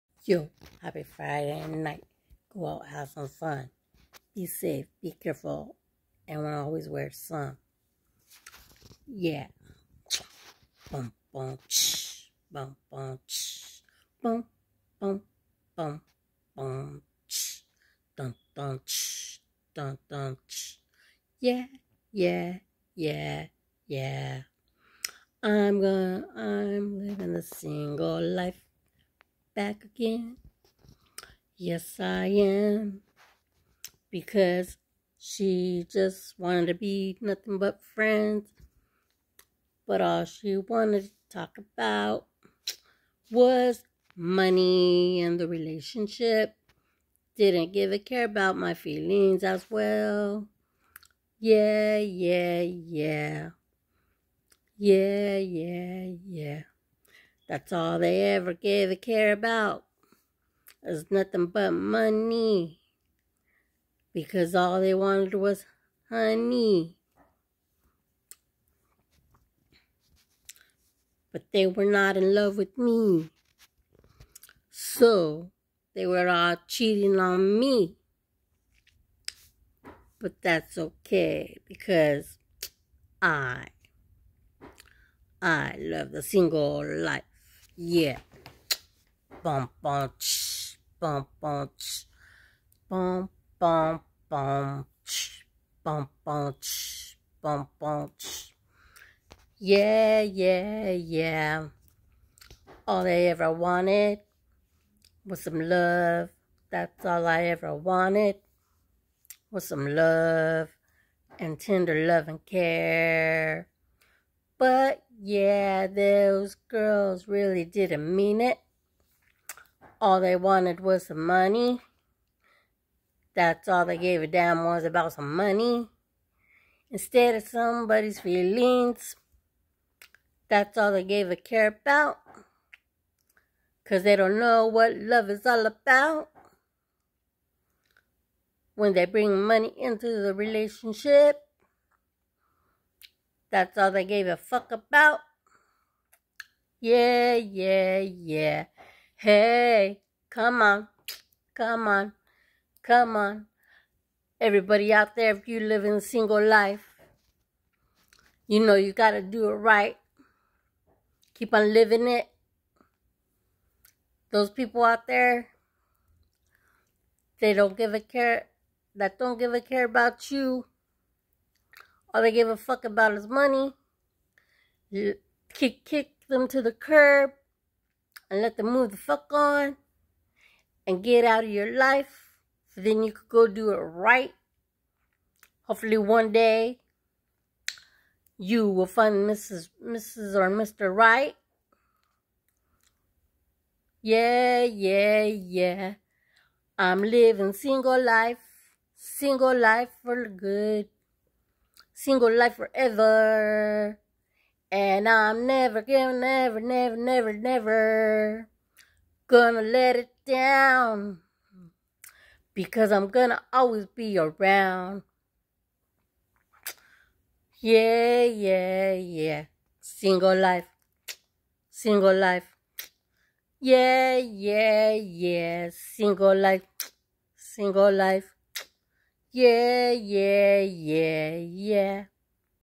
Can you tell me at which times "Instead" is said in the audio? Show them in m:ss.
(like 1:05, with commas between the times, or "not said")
2:06.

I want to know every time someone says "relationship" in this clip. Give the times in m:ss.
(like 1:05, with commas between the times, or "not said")
0:45, 2:20.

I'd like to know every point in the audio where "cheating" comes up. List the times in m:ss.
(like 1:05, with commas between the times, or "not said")
1:16.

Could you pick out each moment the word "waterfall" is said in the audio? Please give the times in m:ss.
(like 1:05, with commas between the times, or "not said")
not said.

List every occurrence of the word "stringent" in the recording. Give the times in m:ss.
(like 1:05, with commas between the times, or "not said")
not said.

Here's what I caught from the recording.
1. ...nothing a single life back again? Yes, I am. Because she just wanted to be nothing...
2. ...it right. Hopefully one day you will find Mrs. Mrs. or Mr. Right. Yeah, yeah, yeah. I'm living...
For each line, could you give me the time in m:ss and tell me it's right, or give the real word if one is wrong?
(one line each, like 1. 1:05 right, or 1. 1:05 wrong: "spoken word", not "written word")
1. 0:27 wrong: "living", not "nothing"
2. 3:03 right.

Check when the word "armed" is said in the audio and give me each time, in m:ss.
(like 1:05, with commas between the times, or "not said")
not said.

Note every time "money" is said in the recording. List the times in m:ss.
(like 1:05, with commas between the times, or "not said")
0:44, 1:01, 2:01, 2:05, 2:19, 2:53.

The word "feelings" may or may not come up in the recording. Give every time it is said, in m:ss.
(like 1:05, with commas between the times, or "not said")
0:48, 2:08.